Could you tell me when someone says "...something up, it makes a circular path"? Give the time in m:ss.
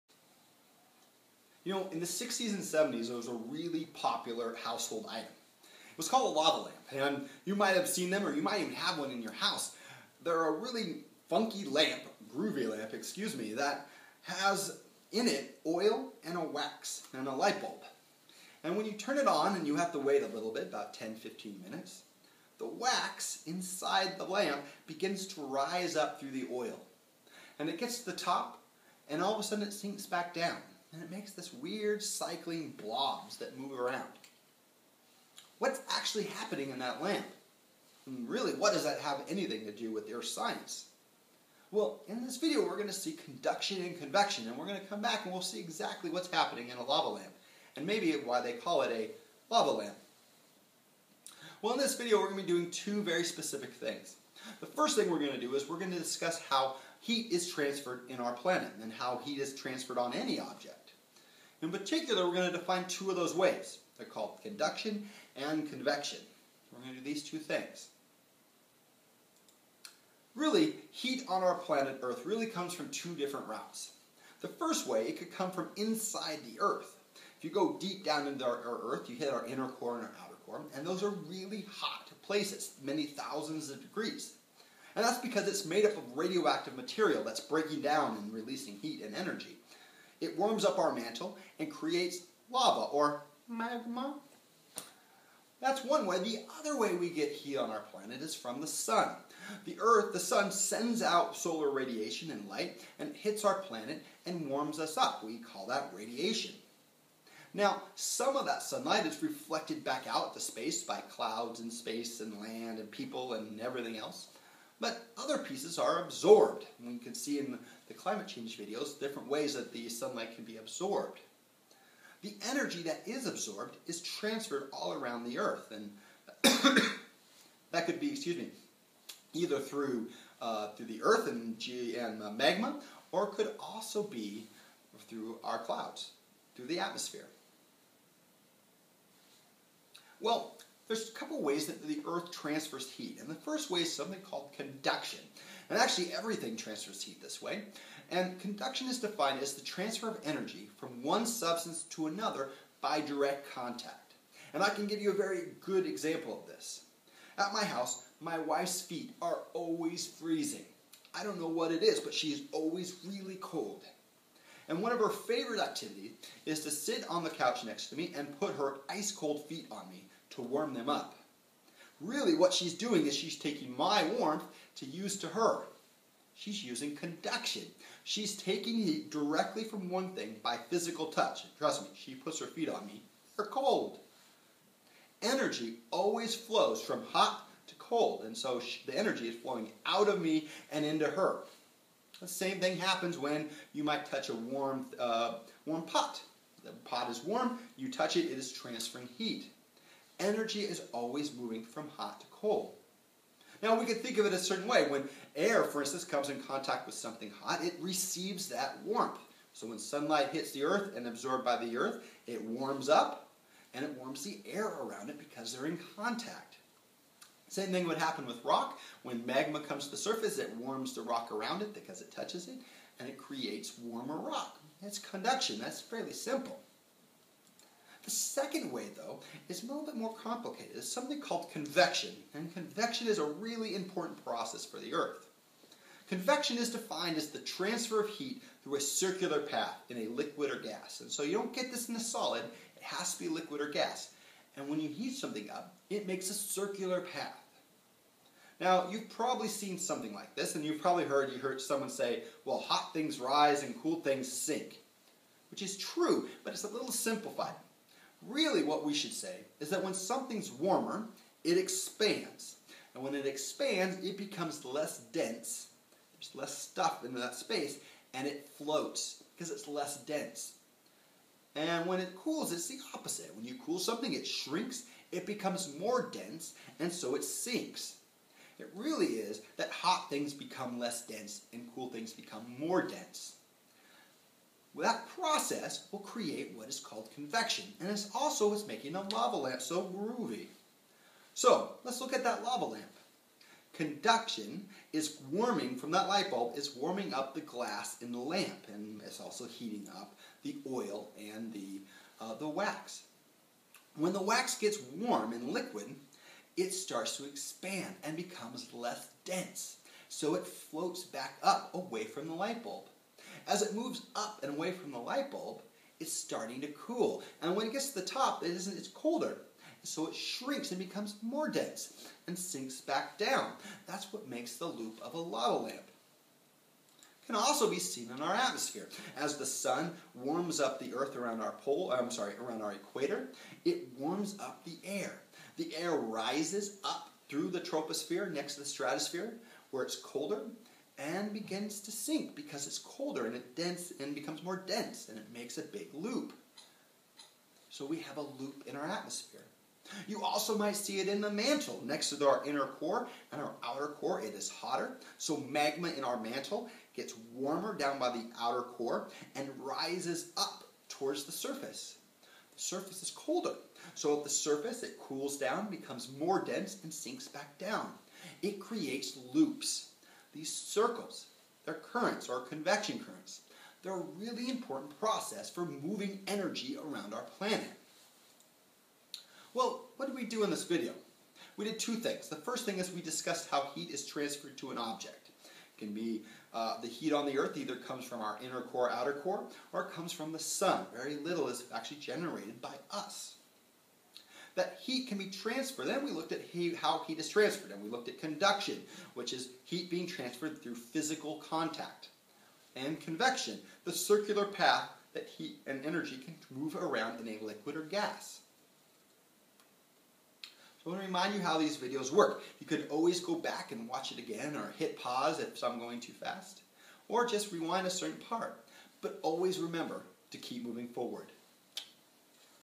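4:05.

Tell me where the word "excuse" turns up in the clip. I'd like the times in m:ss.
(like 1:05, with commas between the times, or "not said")
0:12, 2:08.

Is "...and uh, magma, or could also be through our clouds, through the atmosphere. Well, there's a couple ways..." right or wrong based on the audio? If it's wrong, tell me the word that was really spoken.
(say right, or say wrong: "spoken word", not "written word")
right.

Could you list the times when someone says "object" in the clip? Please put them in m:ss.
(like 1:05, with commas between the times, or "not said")
1:00, 6:24.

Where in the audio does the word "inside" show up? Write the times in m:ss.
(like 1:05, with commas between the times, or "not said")
0:23, 1:15.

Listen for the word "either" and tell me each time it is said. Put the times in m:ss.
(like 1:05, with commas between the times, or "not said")
2:09, 6:27.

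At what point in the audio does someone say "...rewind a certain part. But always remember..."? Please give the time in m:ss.
6:57.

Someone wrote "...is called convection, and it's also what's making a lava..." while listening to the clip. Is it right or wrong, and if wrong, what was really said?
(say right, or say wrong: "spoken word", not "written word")
right.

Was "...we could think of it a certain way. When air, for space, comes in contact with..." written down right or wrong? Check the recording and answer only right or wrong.
wrong.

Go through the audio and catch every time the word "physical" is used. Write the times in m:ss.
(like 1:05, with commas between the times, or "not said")
3:00, 6:40.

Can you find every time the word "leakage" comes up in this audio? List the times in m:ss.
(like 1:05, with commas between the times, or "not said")
not said.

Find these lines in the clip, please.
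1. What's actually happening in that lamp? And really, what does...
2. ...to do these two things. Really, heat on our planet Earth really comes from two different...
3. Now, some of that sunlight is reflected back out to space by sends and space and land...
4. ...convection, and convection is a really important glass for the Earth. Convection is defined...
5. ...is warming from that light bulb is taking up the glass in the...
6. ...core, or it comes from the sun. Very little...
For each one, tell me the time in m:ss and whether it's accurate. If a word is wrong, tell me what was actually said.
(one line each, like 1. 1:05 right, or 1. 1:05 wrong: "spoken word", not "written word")
1. 0:35 right
2. 1:06 right
3. 1:47 wrong: "clouds", not "sends"
4. 3:51 wrong: "process", not "glass"
5. 4:54 wrong: "warming", not "taking"
6. 6:29 right.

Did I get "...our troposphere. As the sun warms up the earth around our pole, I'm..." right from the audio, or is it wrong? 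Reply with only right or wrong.
wrong.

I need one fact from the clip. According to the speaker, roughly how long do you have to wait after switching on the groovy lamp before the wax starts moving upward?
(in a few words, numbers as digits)
10 15 minutes.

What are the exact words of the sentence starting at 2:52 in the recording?
Really, what she's doing is she's taking my warmth to use to her.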